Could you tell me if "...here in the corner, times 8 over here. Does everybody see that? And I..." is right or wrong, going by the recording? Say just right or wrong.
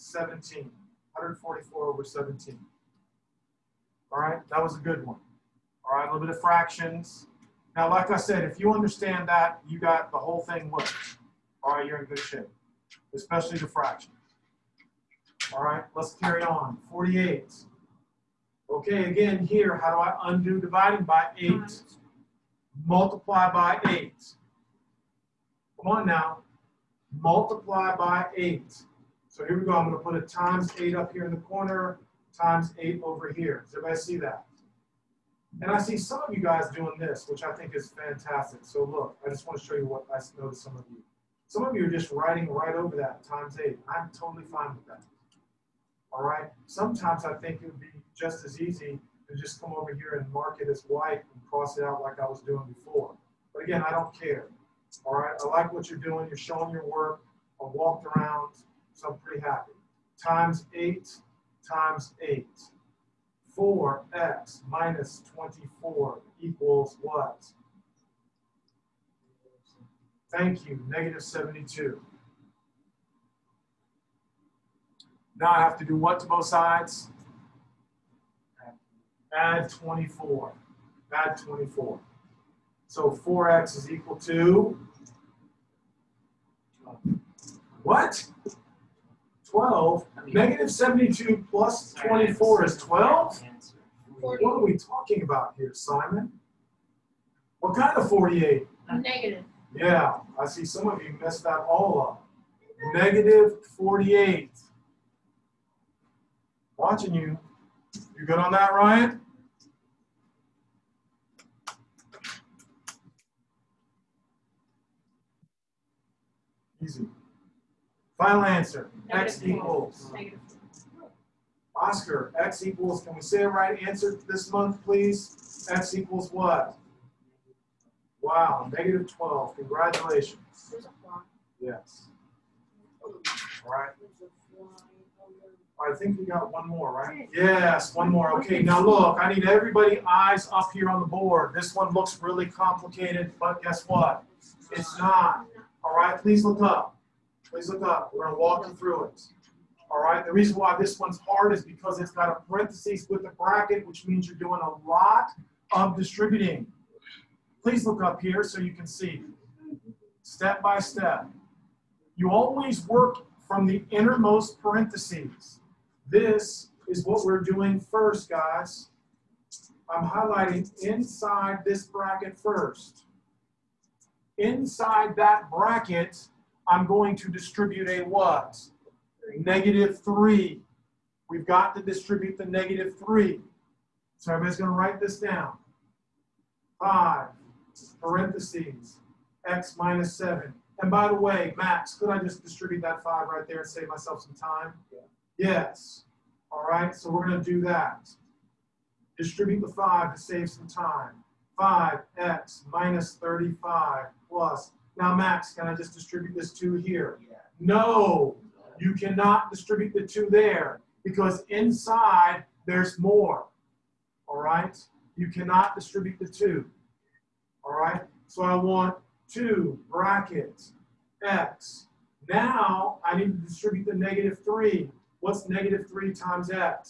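right.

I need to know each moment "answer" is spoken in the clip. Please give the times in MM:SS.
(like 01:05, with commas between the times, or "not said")
01:58, 02:03.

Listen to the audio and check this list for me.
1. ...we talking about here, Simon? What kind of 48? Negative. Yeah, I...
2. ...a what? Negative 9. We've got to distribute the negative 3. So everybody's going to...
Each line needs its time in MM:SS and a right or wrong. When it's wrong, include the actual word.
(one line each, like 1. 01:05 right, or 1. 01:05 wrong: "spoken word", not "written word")
1. 01:34 right
2. 02:57 wrong: "3", not "9".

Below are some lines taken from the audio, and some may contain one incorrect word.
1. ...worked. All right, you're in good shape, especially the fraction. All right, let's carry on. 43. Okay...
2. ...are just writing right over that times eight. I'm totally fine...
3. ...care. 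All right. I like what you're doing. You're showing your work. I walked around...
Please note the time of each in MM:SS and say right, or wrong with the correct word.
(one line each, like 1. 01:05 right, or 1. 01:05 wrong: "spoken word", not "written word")
1. 00:10 wrong: "48", not "43"
2. 00:41 right
3. 00:54 right.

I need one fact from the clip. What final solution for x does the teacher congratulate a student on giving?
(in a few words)
-12.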